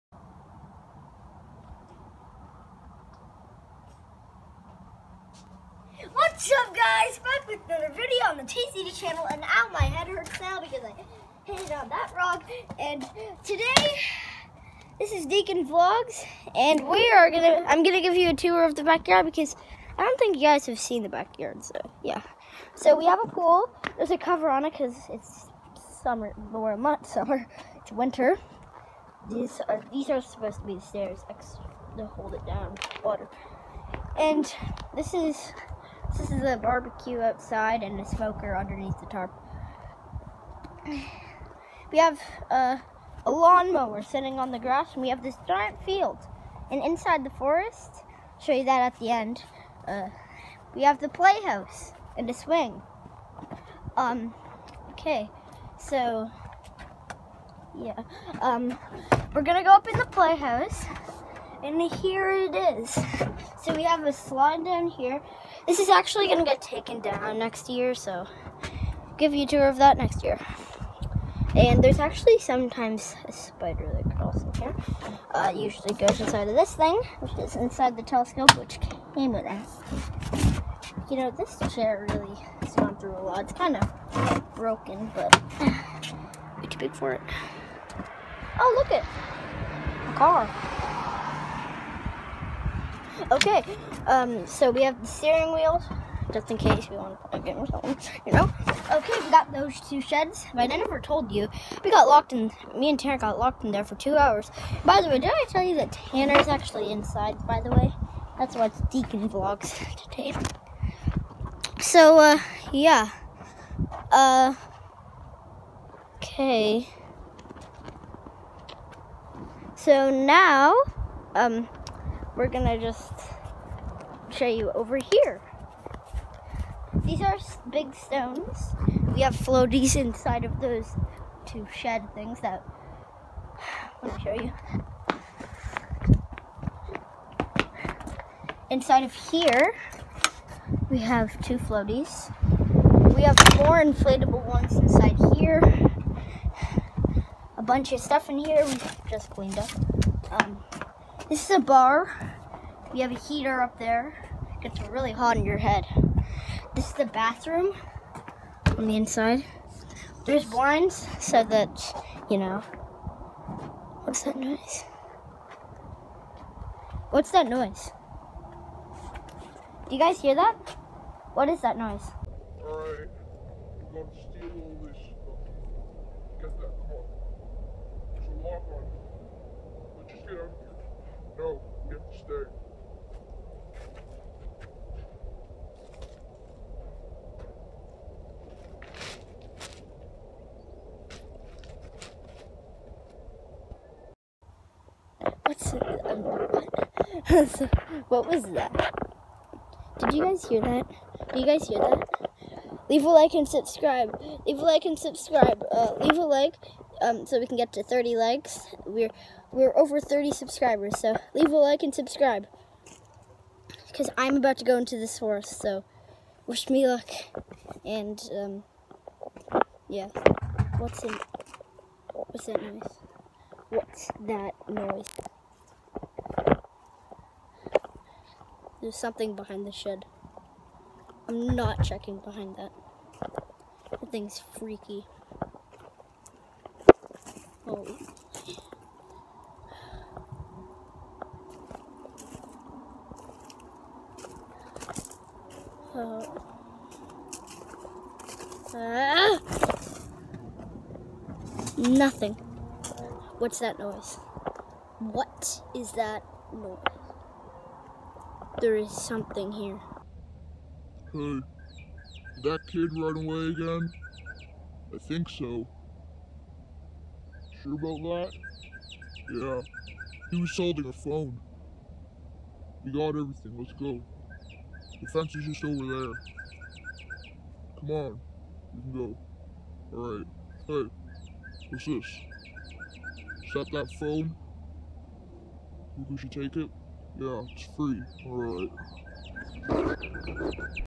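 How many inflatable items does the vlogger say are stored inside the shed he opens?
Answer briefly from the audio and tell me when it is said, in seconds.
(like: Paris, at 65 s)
4, at 143 s.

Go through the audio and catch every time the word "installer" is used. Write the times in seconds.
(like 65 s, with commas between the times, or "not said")
not said.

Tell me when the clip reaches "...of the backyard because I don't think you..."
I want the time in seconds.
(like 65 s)
18 s.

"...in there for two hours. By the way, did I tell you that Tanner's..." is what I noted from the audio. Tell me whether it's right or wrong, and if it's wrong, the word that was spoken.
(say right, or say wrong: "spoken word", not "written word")
right.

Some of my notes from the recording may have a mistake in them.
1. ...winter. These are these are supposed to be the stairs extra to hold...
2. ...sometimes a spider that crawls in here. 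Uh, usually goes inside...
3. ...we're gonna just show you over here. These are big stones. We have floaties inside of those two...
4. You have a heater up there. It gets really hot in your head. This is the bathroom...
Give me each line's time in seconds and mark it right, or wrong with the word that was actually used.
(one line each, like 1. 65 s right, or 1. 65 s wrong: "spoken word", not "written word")
1. 27 s right
2. 72 s right
3. 122 s right
4. 152 s right.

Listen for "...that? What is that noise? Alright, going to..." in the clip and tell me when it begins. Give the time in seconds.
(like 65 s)
170 s.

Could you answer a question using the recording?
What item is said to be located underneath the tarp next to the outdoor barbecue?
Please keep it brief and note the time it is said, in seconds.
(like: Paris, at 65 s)
a smoker, at 37 s.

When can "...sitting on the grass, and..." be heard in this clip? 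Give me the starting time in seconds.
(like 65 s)
44 s.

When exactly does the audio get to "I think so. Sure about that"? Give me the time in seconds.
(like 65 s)
264 s.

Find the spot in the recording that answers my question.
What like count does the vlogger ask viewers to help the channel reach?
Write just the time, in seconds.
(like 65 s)
207 s.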